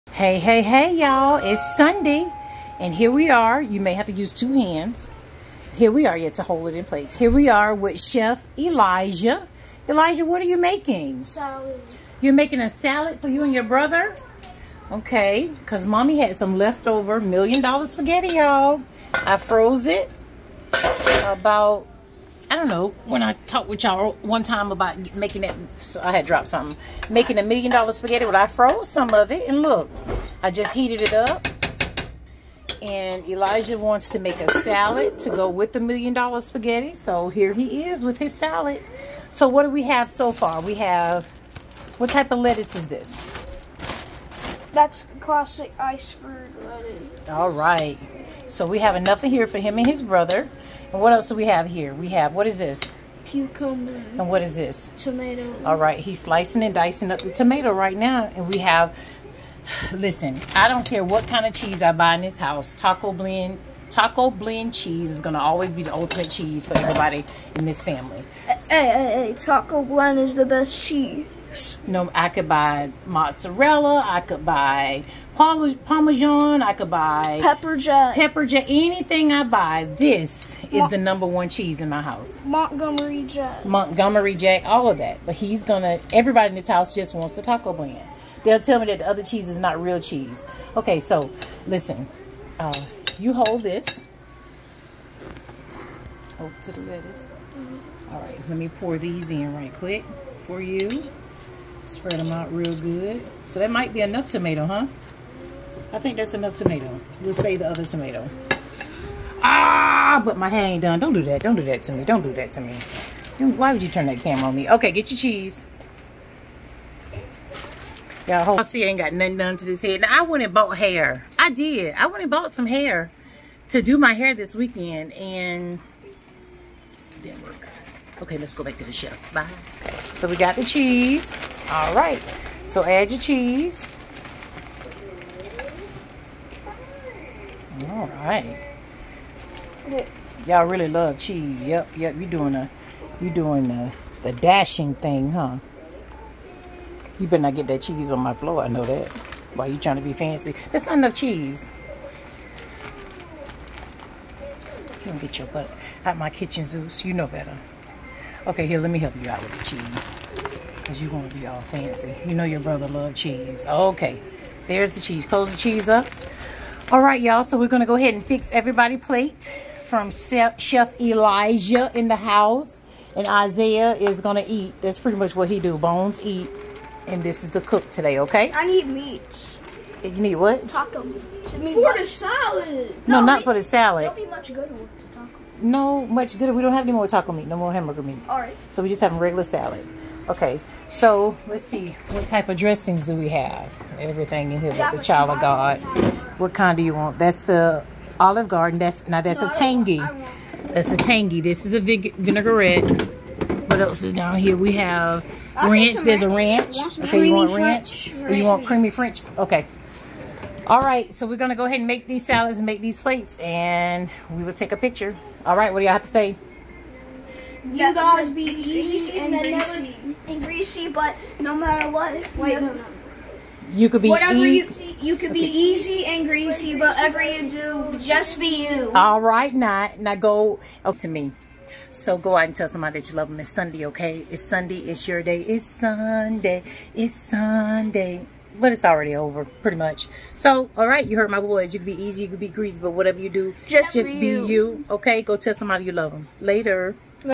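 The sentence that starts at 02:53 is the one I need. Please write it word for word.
And Isaiah is going to eat.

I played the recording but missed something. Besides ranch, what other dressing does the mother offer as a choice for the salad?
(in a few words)
creamy French.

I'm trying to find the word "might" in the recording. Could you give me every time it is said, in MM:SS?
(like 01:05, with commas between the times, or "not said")
01:43.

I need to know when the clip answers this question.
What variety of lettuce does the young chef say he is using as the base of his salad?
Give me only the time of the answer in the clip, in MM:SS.
00:45.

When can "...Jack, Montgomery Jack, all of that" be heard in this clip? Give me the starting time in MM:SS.
01:23.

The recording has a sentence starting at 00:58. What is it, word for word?
And we have, listen, I don't care what kind of cheese I buy in this house.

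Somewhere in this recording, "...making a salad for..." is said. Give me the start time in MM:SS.
00:12.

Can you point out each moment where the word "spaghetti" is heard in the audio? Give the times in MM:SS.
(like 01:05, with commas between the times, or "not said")
00:17, 00:27, 00:36.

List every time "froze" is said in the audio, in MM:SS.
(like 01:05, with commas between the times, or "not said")
00:19, 00:28.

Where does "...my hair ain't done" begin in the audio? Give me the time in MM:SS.
01:50.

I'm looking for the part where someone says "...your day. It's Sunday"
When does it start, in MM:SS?
03:55.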